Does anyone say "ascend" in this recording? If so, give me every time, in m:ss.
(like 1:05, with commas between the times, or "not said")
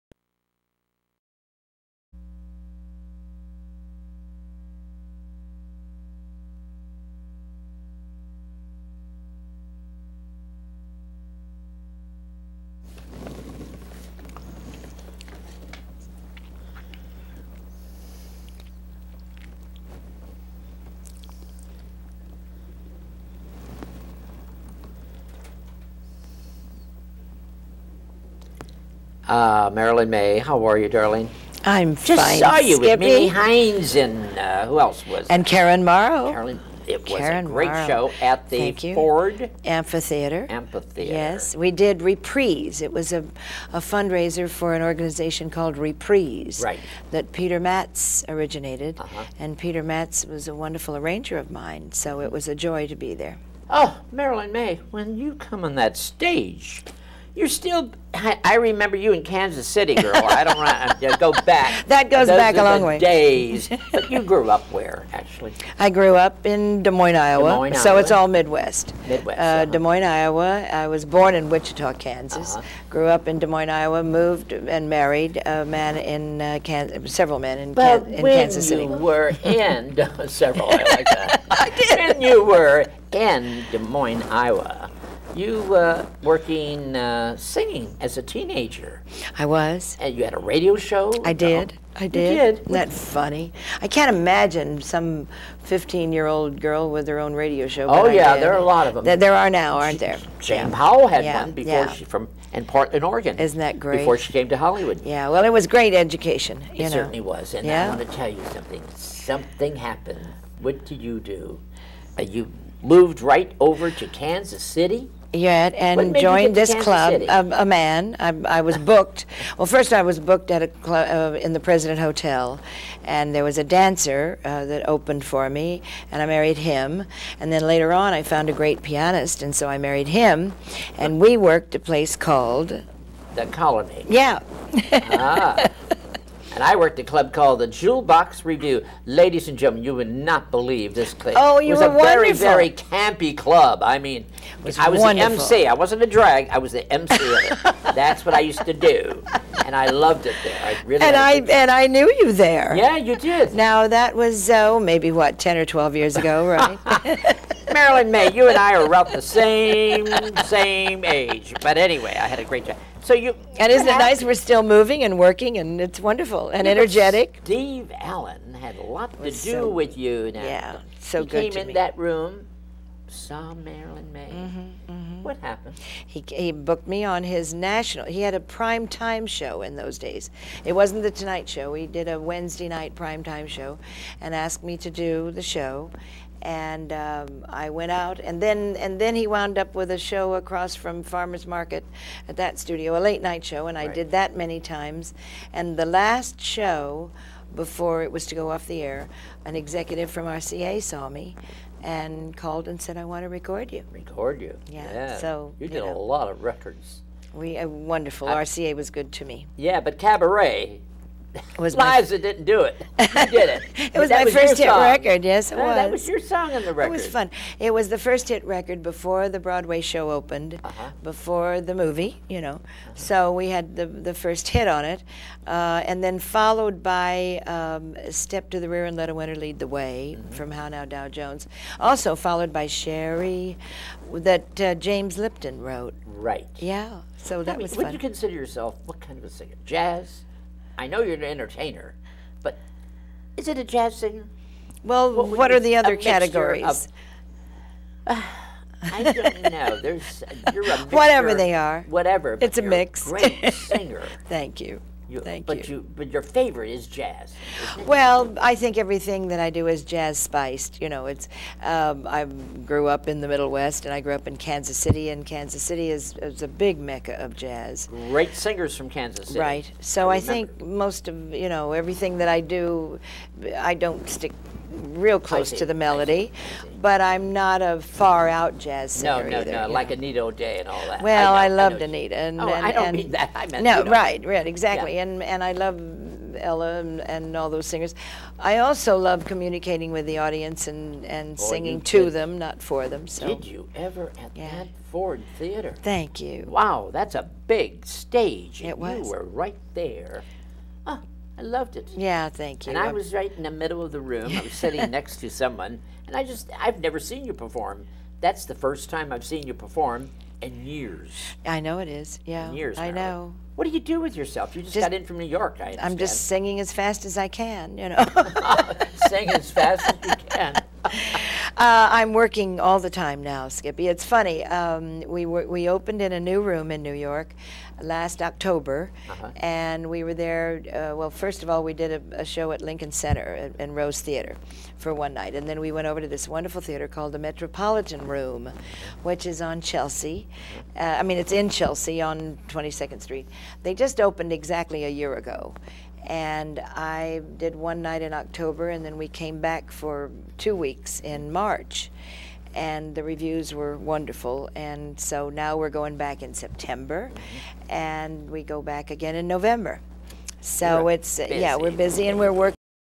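not said.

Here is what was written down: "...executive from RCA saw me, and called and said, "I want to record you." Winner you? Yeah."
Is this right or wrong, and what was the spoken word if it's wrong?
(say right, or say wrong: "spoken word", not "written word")
wrong: "Record", not "Winner".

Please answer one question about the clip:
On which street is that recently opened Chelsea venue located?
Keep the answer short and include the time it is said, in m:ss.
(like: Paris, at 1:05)
22nd Street, at 5:42.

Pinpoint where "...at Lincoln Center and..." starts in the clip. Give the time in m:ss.
5:32.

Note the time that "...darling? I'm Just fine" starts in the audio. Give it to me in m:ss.
0:30.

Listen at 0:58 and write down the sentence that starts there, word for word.
I, I remember you in Kansas City, girl.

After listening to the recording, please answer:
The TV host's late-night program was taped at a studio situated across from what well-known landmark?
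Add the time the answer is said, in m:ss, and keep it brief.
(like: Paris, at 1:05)
Farmers Market, at 3:11.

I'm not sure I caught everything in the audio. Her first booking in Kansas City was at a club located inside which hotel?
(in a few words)
President Hotel.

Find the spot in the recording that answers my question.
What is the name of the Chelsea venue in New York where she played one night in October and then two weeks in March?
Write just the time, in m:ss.
5:37.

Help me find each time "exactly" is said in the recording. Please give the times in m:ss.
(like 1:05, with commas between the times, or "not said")
4:44, 5:44.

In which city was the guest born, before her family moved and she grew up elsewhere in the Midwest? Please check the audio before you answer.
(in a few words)
Wichita.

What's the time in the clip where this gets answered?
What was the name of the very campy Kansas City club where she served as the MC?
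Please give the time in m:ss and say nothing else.
2:17.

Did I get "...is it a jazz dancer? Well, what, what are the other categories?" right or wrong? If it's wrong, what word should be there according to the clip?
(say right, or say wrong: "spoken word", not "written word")
wrong: "singer", not "dancer".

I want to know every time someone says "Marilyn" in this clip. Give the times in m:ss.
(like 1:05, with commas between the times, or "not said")
0:29, 0:54, 2:37, 2:53.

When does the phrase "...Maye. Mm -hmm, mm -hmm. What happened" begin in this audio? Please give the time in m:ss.
2:54.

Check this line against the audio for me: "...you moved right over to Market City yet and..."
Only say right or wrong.
wrong.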